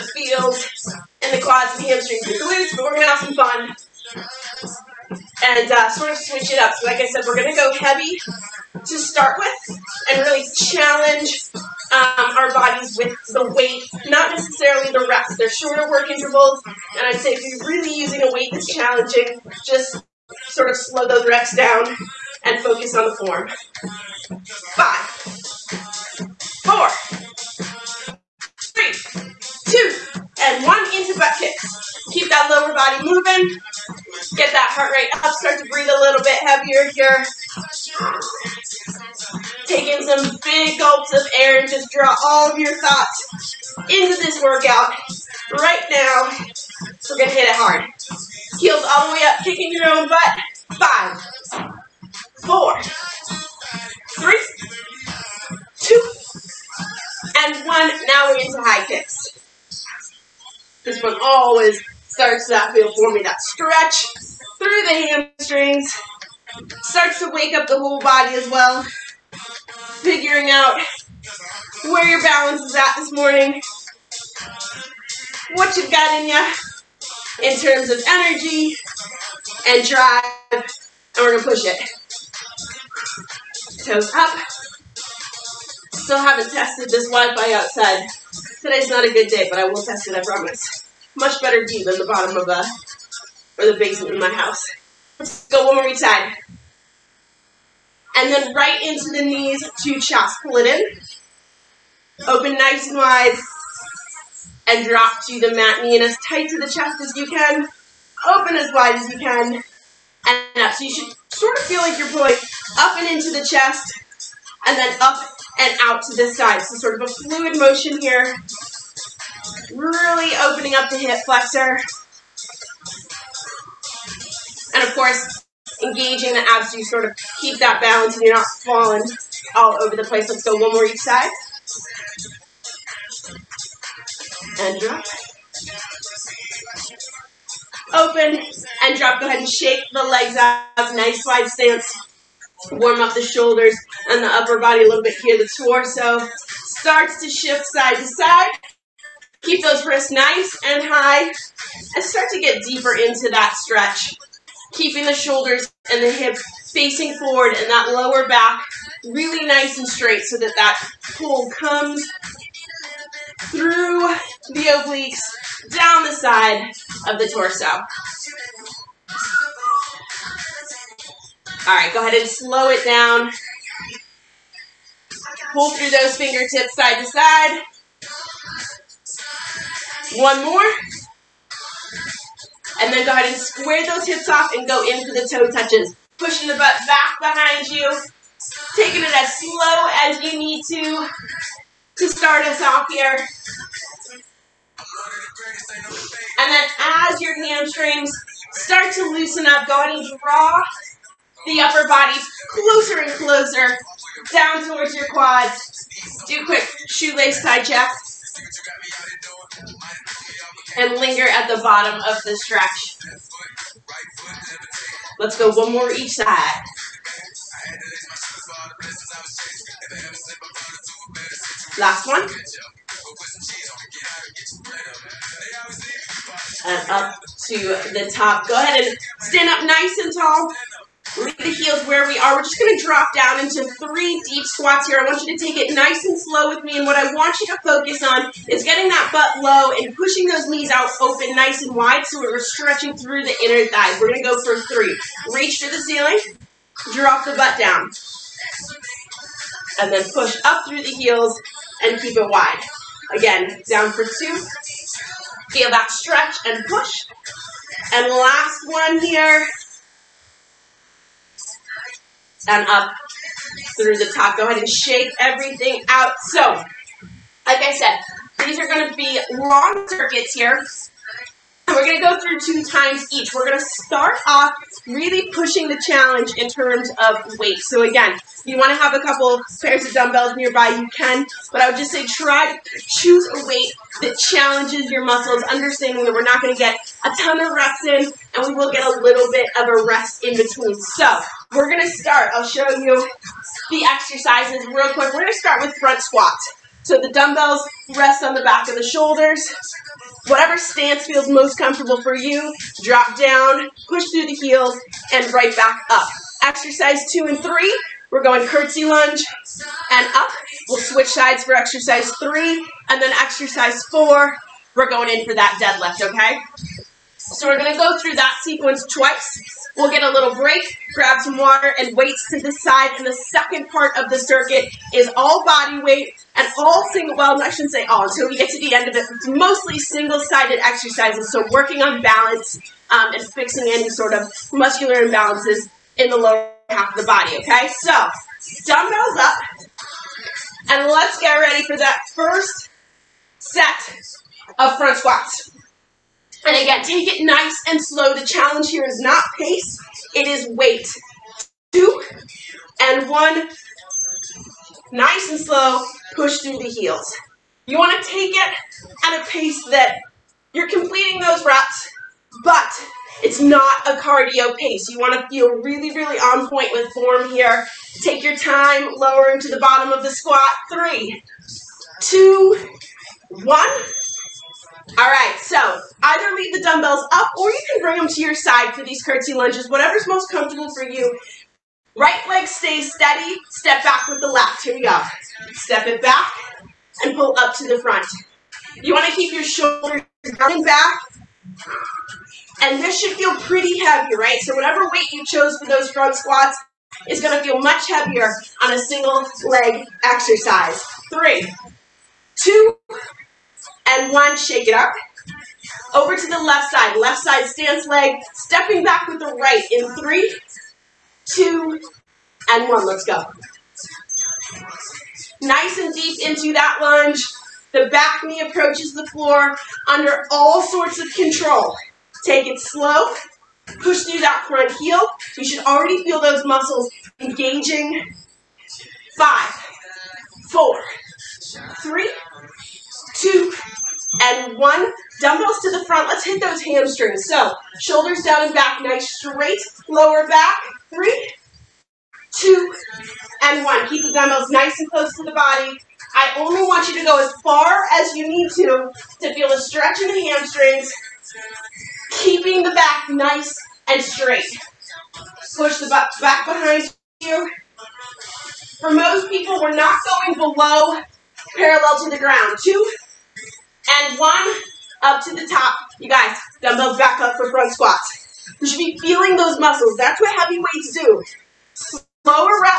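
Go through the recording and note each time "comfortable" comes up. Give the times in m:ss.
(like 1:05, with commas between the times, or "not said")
5:01, 6:20.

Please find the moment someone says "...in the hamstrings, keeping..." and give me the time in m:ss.
7:30.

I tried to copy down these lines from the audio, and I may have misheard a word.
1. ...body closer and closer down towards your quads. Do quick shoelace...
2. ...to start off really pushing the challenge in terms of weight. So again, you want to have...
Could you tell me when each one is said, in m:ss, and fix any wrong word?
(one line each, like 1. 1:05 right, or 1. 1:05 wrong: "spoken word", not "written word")
1. 3:21 right
2. 4:33 right.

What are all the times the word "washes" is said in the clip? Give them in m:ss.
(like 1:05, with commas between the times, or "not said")
not said.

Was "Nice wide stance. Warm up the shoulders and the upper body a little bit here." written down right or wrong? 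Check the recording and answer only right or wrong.
right.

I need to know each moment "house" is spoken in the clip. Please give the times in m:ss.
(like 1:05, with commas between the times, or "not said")
1:34.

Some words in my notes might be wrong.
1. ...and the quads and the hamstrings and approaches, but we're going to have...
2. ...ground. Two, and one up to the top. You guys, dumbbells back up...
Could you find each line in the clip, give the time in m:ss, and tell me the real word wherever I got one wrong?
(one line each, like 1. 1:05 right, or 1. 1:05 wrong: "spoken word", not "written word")
1. 0:01 wrong: "glutes", not "approaches"
2. 7:42 right.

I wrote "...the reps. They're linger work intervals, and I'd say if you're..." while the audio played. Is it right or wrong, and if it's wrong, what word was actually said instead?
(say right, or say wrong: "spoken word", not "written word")
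wrong: "shorter", not "linger".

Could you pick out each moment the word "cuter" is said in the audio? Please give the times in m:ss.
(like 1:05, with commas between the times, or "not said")
not said.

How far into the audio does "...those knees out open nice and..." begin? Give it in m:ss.
4:00.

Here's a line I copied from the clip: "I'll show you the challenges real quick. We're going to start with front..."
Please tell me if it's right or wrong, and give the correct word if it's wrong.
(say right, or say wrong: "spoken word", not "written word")
wrong: "exercises", not "challenges".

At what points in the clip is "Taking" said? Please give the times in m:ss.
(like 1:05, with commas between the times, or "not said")
0:39, 3:08.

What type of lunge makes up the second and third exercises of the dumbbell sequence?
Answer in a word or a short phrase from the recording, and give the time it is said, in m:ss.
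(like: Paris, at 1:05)
Curtsy lunge, at 5:08.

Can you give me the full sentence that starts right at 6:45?
Over to the left side, left side stance leg, stepping back with the right in three, two, and one.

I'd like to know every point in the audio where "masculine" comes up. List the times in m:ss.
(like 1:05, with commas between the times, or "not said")
not said.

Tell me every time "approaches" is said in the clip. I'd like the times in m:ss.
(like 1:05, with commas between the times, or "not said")
6:58.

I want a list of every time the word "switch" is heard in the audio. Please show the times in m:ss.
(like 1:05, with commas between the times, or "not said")
0:06, 5:10.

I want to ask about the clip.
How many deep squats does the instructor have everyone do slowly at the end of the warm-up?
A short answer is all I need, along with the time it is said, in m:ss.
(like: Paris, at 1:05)
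3, at 3:53.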